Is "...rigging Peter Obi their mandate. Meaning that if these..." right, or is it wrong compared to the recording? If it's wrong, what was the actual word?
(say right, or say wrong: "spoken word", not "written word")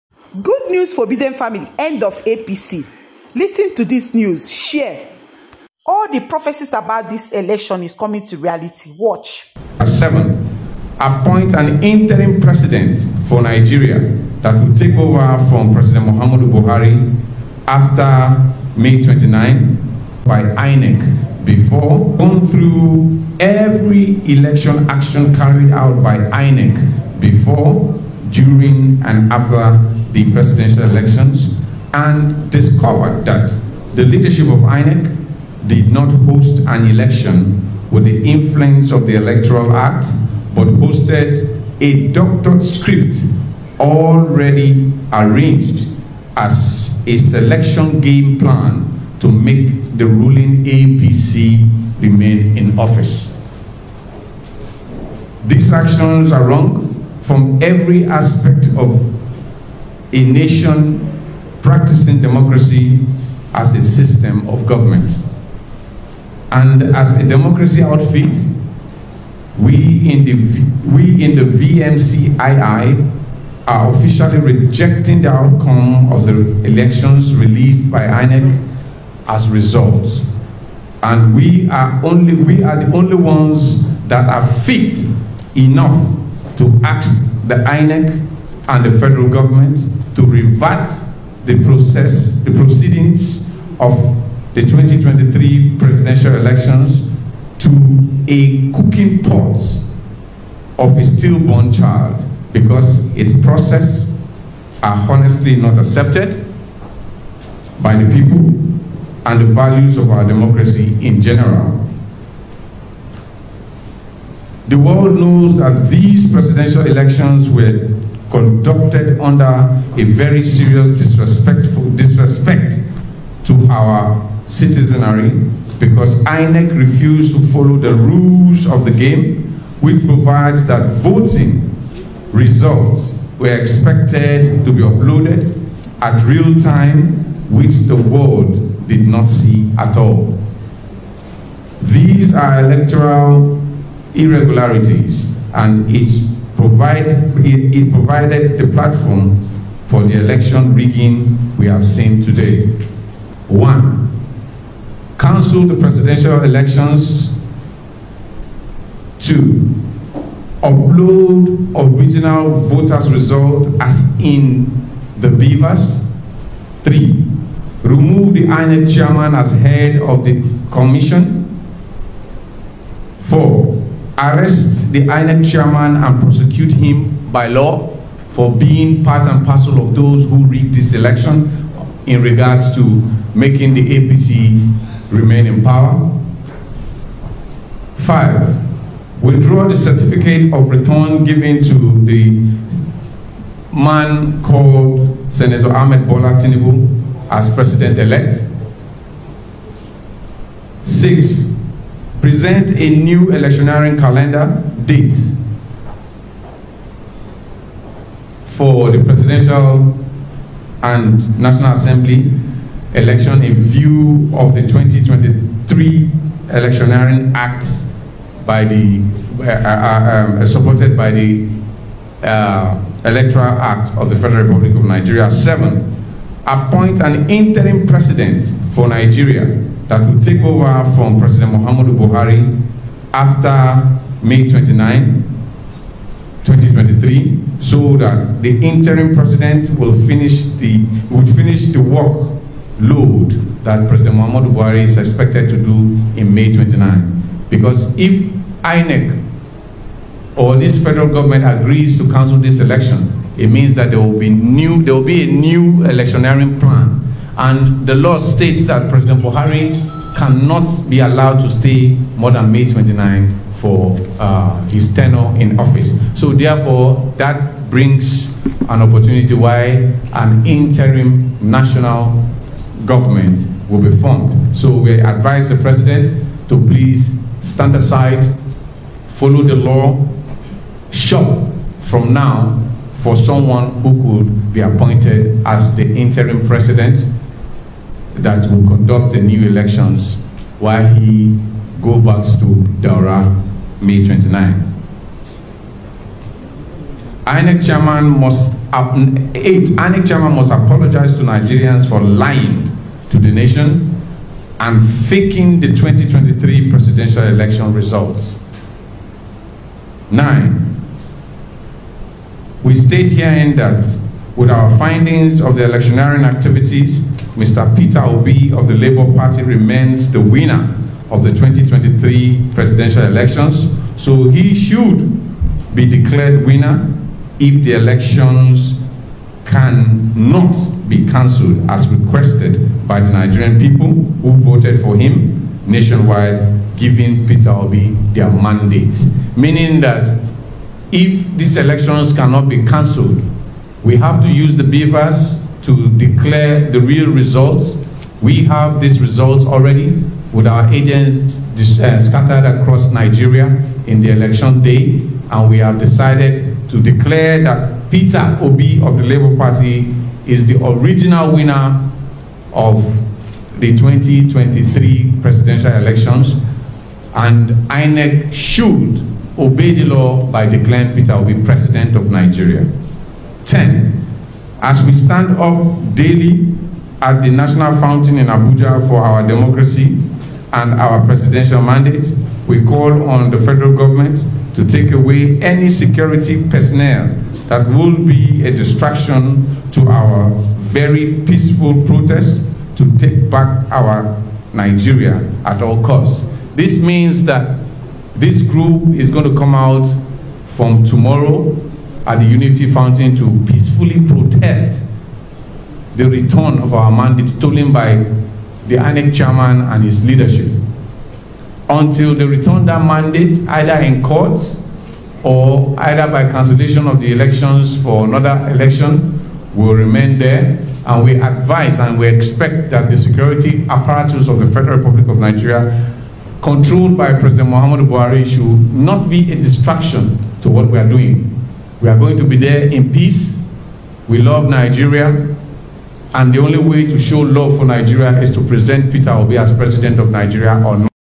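wrong: "giving", not "rigging".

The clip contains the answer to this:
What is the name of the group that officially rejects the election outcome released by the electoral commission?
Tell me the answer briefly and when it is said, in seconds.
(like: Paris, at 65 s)
VMCII, at 71 s.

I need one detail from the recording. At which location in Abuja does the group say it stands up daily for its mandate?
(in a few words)
National Fountain.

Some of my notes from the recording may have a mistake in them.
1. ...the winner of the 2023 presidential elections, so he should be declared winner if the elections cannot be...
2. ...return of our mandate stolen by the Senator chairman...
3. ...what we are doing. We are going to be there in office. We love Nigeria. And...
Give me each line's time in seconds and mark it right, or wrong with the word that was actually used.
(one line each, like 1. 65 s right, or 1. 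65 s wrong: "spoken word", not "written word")
1. 320 s right
2. 406 s wrong: "INEC", not "Senator"
3. 430 s wrong: "peace", not "office".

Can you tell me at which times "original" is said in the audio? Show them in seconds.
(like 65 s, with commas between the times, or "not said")
161 s, 360 s.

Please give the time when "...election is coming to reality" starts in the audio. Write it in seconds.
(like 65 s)
7 s.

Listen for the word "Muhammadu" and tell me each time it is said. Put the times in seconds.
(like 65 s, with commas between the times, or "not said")
16 s, 231 s, 244 s, 427 s.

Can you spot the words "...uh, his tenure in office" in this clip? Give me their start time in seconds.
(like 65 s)
264 s.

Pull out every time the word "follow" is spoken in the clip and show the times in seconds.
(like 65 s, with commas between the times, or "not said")
127 s, 279 s.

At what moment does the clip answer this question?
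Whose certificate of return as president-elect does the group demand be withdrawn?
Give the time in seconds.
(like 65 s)
195 s.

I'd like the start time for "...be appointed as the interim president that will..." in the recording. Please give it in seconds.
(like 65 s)
284 s.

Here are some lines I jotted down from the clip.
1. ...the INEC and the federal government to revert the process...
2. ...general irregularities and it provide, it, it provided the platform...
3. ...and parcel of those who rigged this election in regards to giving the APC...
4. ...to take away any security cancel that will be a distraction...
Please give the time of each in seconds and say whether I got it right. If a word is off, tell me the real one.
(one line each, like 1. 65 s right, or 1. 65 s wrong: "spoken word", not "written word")
1. 87 s right
2. 142 s wrong: "electoral", not "general"
3. 179 s wrong: "making", not "giving"
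4. 384 s wrong: "personnel", not "cancel".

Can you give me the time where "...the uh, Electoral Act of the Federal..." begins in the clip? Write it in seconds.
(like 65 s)
221 s.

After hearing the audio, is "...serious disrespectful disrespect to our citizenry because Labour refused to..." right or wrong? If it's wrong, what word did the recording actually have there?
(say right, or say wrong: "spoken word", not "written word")
wrong: "INEC", not "Labour".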